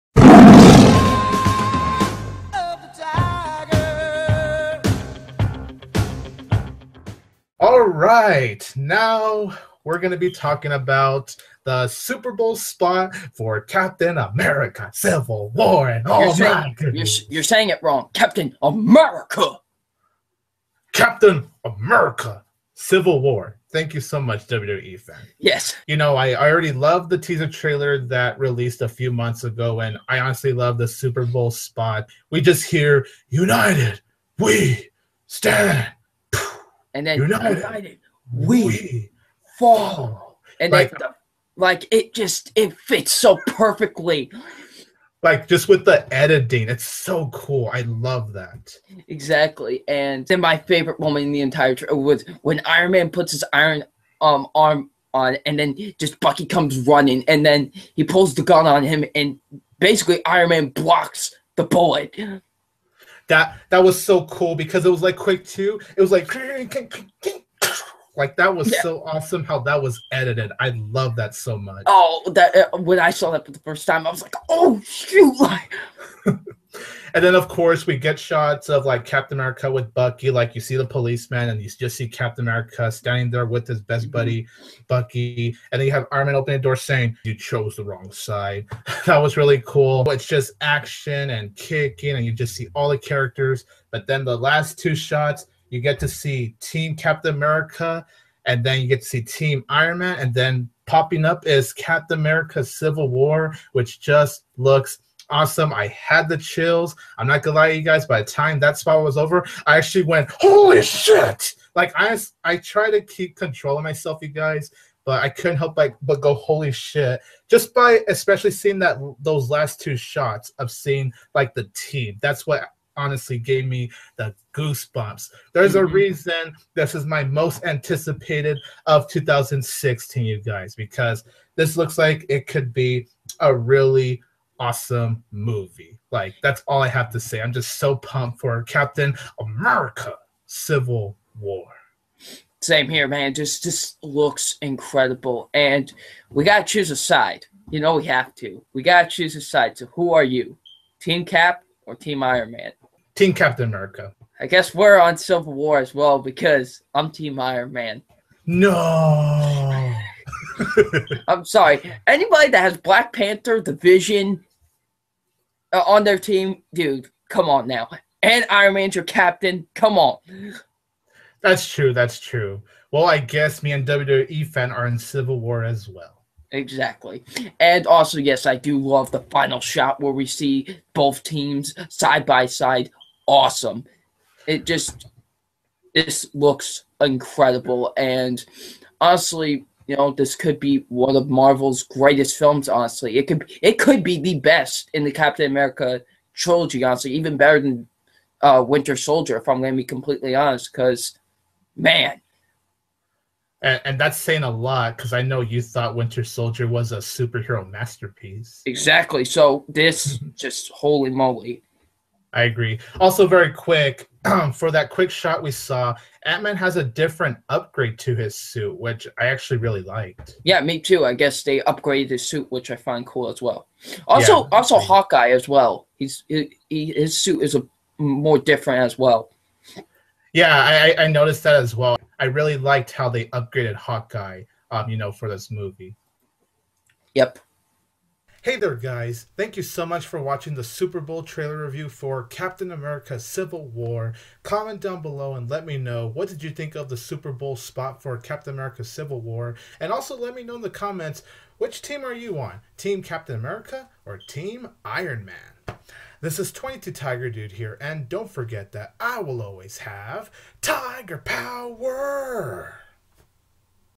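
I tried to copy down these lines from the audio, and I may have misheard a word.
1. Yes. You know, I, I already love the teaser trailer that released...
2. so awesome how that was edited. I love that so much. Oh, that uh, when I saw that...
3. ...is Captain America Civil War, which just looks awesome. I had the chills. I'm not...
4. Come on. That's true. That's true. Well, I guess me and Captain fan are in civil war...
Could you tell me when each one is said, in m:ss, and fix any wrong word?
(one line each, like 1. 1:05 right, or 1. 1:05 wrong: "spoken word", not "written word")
1. 0:25 right
2. 1:08 right
3. 1:41 right
4. 2:49 wrong: "WWE", not "Captain".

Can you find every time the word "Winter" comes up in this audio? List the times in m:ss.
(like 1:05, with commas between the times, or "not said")
3:18, 3:25.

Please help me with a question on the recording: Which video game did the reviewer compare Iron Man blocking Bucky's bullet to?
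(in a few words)
Quake 2.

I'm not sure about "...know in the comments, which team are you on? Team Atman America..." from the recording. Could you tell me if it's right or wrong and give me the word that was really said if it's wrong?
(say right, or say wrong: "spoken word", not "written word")
wrong: "Captain", not "Atman".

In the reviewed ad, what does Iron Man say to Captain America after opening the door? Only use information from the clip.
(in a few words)
You chose the wrong side.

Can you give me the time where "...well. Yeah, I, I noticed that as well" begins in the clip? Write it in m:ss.
3:48.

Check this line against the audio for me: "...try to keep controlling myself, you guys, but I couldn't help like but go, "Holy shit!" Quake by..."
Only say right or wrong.
wrong.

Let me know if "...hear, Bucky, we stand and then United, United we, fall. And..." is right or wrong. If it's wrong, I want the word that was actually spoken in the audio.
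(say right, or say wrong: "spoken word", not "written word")
wrong: "United", not "Bucky".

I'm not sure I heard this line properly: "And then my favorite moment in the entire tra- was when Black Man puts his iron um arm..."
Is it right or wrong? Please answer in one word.
wrong.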